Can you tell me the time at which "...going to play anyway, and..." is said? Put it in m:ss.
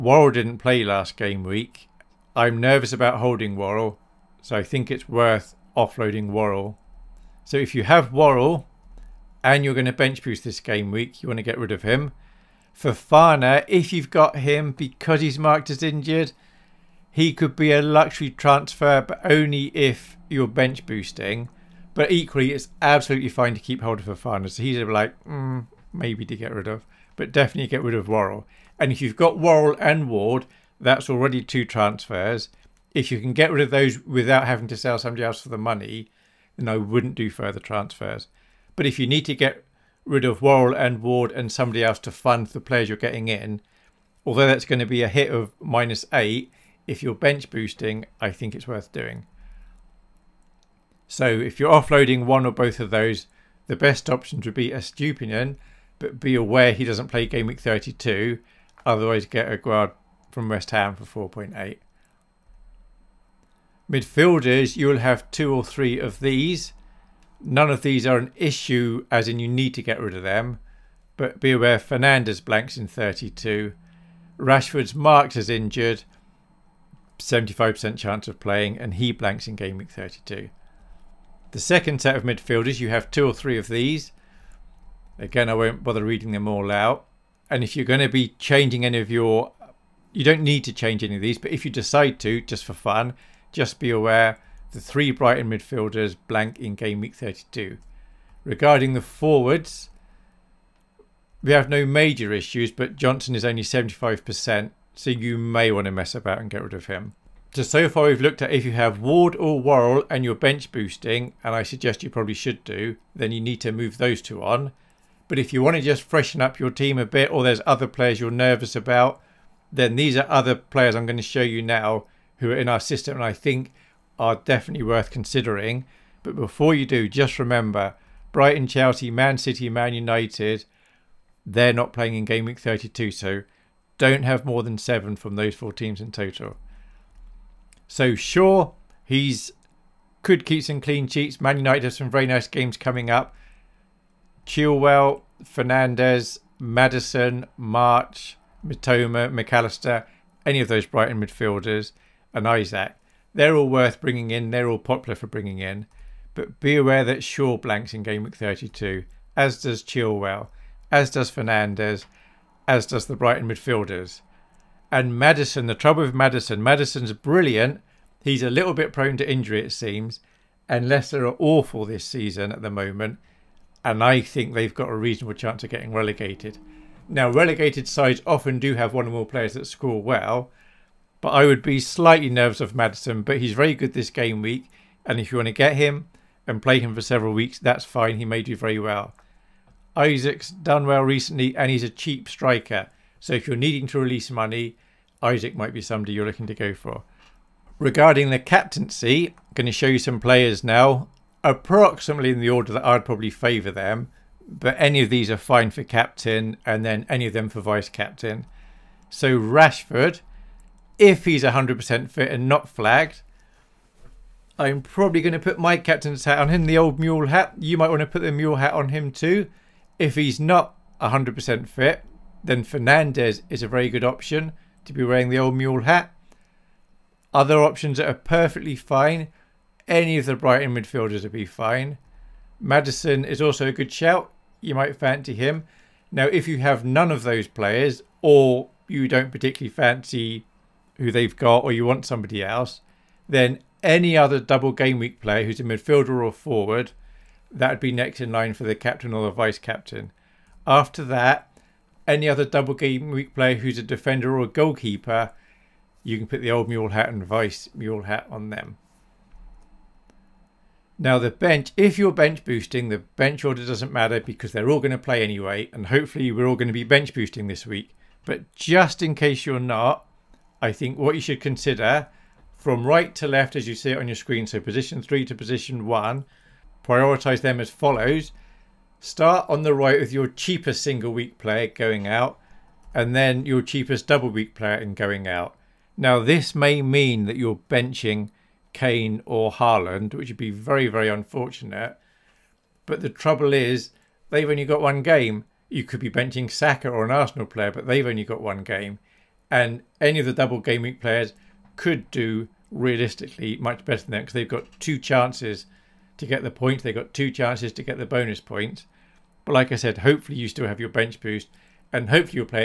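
4:24.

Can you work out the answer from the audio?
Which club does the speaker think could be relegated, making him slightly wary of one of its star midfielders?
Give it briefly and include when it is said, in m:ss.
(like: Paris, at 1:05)
Leicester, at 2:50.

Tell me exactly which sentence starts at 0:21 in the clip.
But equally, it's absolutely fine to keep hold of Fofana.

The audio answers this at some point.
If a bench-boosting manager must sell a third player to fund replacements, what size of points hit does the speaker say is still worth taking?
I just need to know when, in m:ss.
0:45.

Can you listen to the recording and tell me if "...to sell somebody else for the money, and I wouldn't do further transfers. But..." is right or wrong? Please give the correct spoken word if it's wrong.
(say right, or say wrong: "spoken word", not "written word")
right.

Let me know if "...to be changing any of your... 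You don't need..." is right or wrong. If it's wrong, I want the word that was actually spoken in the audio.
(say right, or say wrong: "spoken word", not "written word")
right.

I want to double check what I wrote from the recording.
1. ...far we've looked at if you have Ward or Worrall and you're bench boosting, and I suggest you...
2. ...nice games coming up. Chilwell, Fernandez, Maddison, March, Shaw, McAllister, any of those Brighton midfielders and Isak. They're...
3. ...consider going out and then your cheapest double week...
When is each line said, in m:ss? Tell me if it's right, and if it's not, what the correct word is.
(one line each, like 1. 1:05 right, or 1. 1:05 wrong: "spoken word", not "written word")
1. 1:47 right
2. 2:22 wrong: "Mitoma", not "Shaw"
3. 4:41 wrong: "player", not "consider".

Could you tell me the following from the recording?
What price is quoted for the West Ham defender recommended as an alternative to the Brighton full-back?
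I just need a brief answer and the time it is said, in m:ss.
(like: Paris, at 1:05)
4.8, at 1:01.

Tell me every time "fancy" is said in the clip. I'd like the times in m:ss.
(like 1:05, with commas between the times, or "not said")
3:54, 3:59.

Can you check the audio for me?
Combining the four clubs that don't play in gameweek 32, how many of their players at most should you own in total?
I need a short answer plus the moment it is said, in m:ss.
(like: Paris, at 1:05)
7, at 2:14.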